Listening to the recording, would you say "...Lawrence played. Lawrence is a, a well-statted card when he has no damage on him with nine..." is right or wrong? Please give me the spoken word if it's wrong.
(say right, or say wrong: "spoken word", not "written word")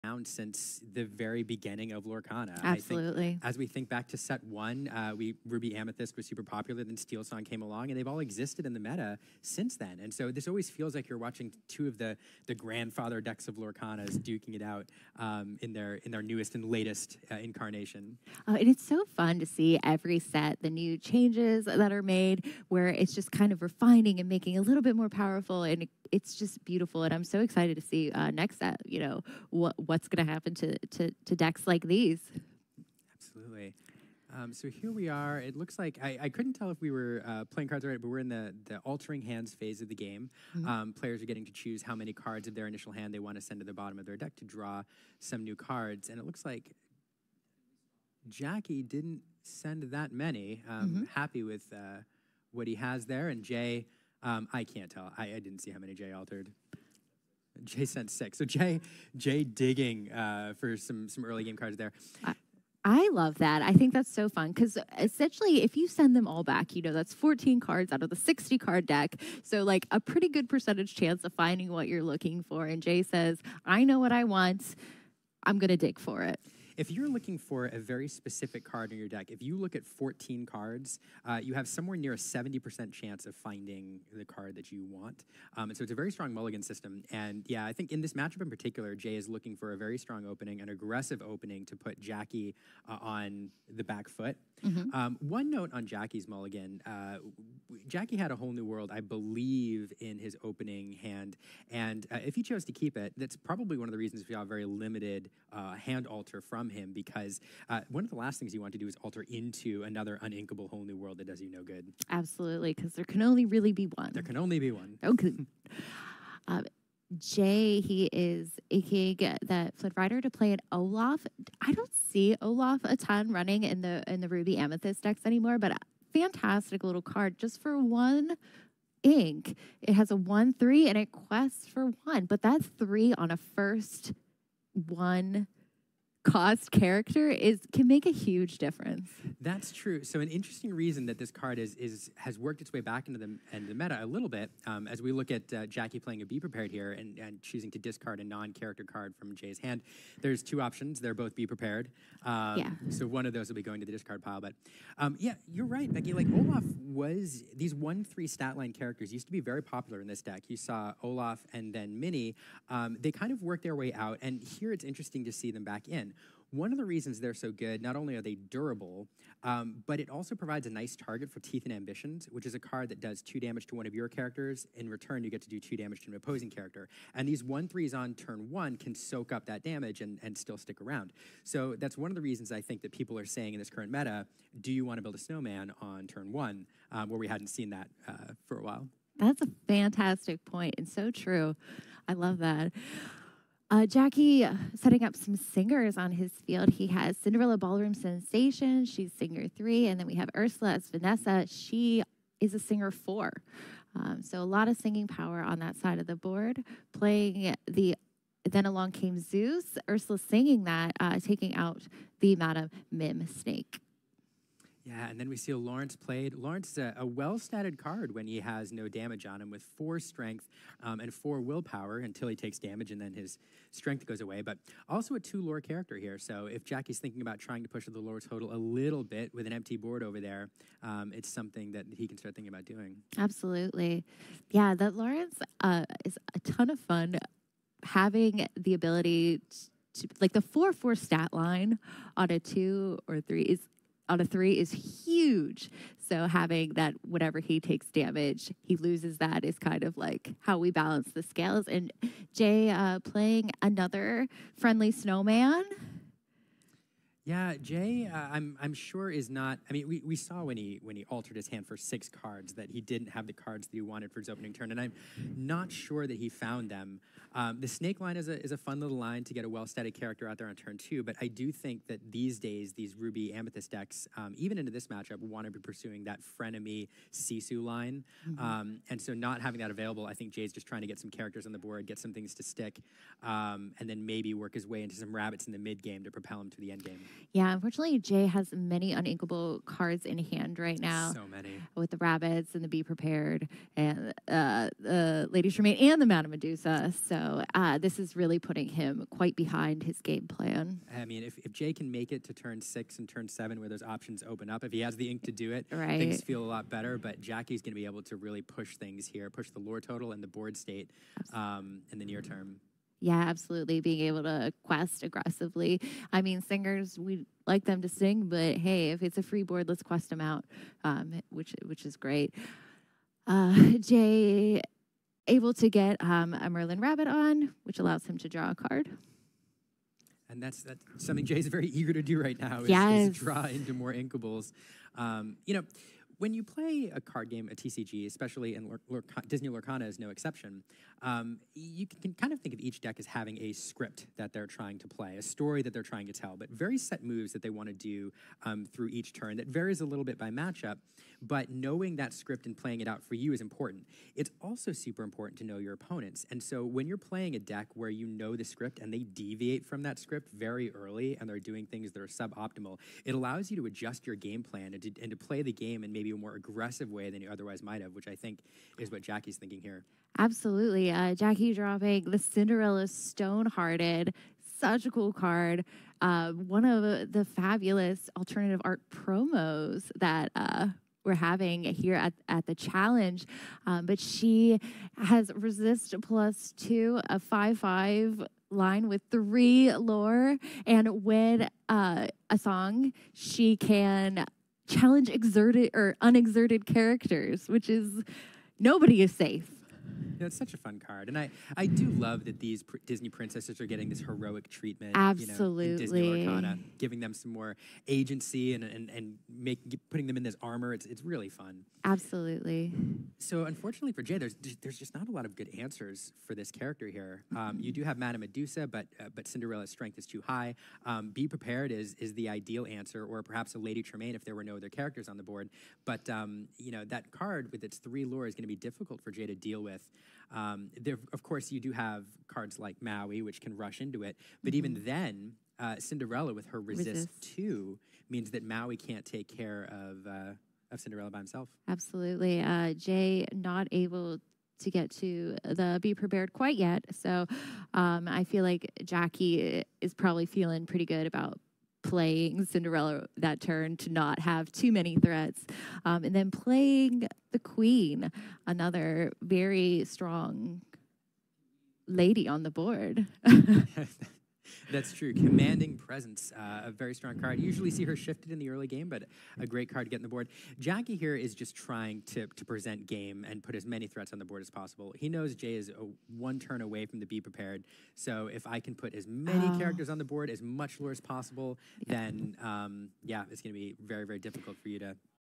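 wrong: "four", not "nine".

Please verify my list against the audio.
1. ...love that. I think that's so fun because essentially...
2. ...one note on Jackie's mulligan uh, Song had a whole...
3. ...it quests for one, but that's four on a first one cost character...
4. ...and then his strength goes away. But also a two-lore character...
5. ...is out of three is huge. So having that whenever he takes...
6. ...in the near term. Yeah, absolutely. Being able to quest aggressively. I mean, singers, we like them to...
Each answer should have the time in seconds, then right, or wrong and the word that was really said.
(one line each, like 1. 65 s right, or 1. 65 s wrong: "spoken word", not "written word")
1. 63 s right
2. 95 s wrong: "Jackie", not "Song"
3. 130 s wrong: "three", not "four"
4. 222 s right
5. 243 s right
6. 311 s right.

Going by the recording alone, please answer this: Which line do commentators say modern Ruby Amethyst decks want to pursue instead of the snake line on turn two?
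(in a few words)
Frenemy Sisu line.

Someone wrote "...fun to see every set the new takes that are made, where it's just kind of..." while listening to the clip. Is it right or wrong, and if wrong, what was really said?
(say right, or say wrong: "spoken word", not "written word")
wrong: "changes", not "takes".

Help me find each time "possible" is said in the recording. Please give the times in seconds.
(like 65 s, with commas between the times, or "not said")
474 s, 481 s.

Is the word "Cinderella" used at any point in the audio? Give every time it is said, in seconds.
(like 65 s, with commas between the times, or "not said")
197 s, 372 s, 419 s, 435 s, 440 s, 452 s.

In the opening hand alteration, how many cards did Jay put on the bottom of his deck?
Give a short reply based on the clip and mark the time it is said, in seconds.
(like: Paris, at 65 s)
6, at 57 s.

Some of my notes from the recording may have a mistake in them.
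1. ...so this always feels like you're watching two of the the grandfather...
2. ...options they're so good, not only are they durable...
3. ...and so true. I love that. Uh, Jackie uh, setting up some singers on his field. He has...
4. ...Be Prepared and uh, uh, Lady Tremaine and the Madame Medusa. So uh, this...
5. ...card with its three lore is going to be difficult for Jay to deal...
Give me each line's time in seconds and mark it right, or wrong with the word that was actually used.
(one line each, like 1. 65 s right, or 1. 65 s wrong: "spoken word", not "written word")
1. 10 s right
2. 166 s wrong: "reasons", not "options"
3. 190 s right
4. 292 s right
5. 427 s right.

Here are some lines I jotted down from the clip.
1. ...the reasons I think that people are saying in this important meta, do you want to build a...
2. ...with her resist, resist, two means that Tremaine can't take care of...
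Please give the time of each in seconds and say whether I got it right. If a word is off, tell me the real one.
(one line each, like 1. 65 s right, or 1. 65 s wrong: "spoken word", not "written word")
1. 182 s wrong: "current", not "important"
2. 436 s wrong: "Maui", not "Tremaine".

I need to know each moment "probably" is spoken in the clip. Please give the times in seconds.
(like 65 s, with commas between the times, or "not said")
103 s, 449 s.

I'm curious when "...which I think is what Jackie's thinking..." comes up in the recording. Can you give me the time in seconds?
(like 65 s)
367 s.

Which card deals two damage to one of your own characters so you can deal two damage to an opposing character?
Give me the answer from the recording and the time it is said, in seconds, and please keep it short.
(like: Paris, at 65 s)
Teeth and Ambitions, at 171 s.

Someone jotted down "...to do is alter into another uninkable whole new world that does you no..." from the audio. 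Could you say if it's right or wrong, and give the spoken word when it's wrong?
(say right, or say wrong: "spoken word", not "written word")
right.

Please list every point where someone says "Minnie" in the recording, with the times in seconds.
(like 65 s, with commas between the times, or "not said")
161 s.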